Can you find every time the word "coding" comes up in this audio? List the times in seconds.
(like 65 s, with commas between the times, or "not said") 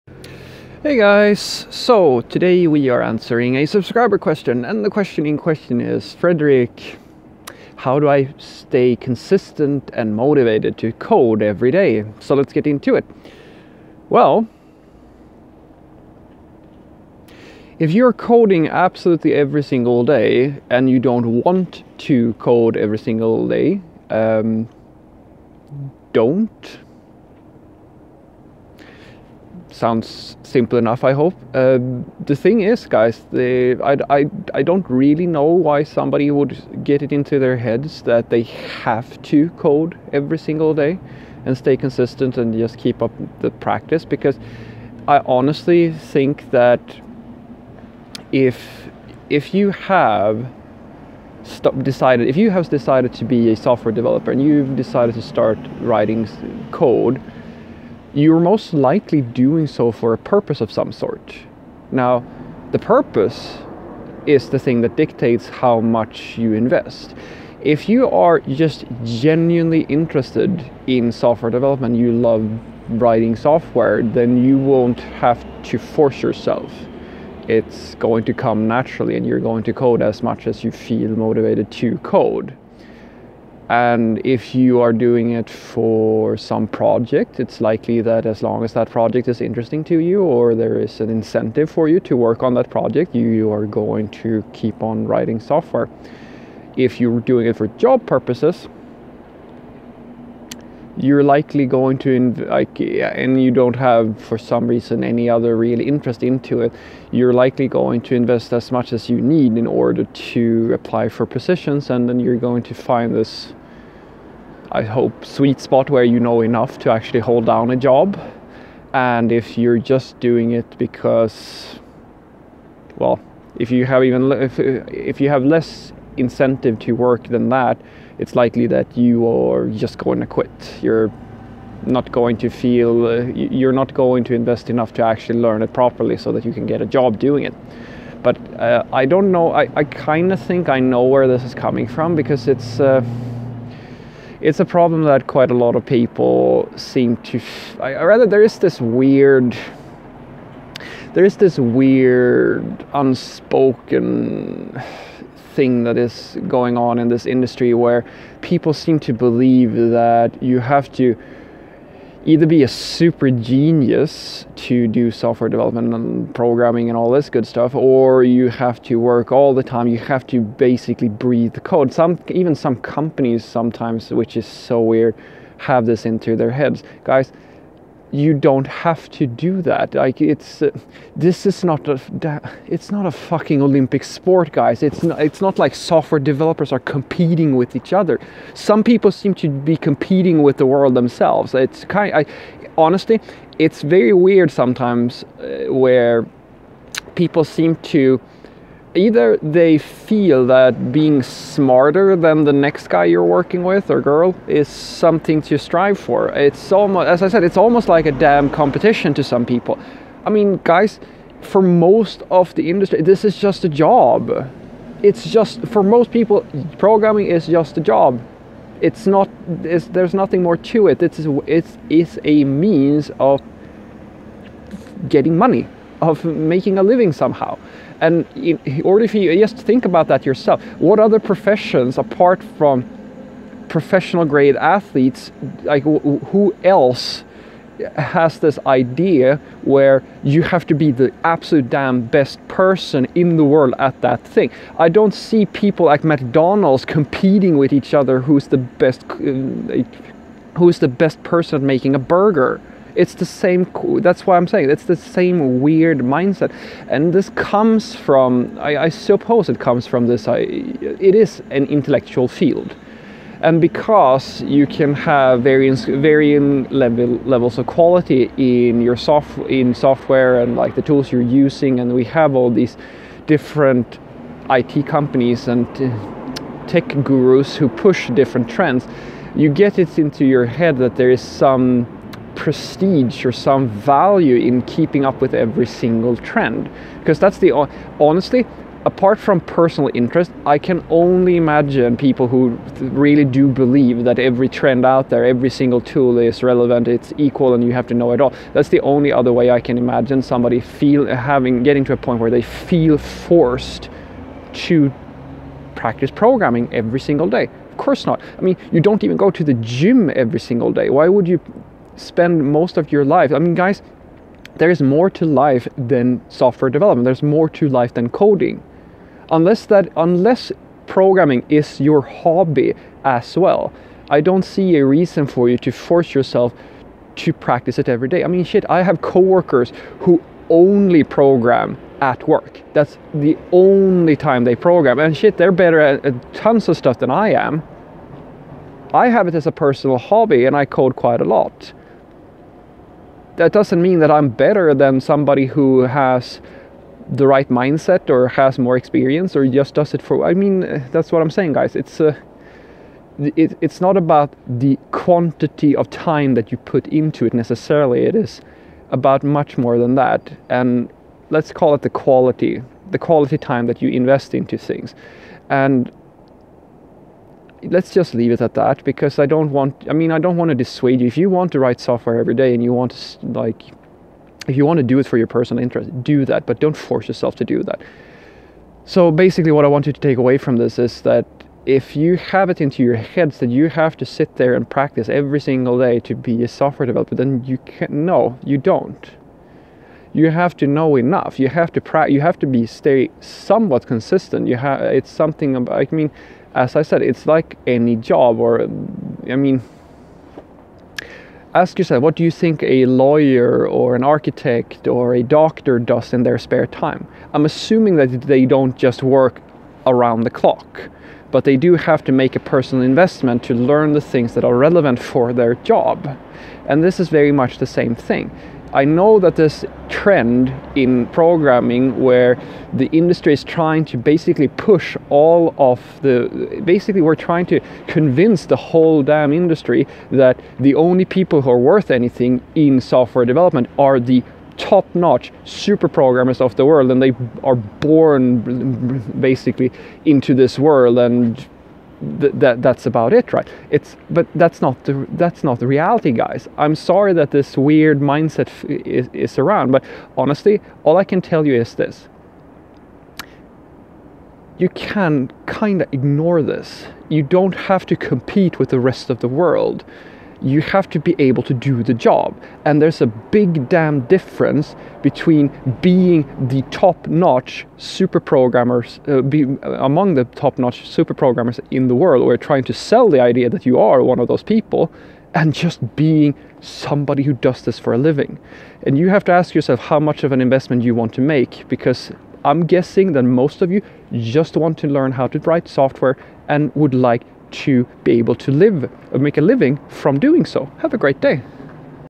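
18 s, 318 s.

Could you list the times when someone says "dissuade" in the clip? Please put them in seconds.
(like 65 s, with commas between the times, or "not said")
370 s.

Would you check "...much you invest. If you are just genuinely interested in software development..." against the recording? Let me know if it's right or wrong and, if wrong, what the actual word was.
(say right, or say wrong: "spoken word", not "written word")
right.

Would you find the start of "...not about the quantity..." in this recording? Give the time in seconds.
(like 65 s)
353 s.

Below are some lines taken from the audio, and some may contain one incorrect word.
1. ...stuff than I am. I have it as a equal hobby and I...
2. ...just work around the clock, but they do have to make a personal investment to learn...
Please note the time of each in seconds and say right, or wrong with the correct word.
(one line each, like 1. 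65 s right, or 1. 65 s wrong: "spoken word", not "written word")
1. 336 s wrong: "personal", not "equal"
2. 408 s right.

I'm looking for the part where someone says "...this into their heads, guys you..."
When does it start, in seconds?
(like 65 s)
175 s.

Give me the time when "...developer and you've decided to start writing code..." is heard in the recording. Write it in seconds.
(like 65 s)
53 s.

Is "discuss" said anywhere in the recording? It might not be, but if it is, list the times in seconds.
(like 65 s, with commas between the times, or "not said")
not said.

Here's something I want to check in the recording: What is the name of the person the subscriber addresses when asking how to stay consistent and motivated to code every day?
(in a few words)
Fredrik.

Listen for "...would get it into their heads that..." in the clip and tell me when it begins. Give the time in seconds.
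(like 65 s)
36 s.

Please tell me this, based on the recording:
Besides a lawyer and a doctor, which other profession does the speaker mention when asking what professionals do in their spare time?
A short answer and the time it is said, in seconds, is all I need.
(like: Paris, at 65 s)
architect, at 404 s.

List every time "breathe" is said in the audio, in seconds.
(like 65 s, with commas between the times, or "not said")
171 s.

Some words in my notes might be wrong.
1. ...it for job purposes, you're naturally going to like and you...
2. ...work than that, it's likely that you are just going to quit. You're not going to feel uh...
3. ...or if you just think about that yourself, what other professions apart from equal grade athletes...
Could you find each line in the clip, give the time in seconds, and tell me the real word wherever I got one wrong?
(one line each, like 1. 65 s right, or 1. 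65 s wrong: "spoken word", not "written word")
1. 97 s wrong: "likely", not "naturally"
2. 126 s right
3. 228 s wrong: "professional", not "equal".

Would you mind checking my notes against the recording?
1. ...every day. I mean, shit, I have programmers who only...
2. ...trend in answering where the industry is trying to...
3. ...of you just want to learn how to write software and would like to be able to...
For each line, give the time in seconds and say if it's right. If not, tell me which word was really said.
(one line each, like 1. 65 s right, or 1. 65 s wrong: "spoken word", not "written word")
1. 327 s wrong: "coworkers", not "programmers"
2. 419 s wrong: "programming", not "answering"
3. 483 s right.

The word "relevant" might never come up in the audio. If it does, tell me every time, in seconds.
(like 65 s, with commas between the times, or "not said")
296 s, 414 s.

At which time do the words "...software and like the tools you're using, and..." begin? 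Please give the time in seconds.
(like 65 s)
269 s.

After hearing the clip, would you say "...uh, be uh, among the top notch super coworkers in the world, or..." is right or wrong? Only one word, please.
wrong.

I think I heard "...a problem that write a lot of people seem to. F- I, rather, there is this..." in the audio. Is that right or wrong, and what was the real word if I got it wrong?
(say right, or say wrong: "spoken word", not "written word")
wrong: "quite", not "write".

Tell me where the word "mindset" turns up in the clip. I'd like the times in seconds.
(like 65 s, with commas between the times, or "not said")
255 s, 347 s, 447 s.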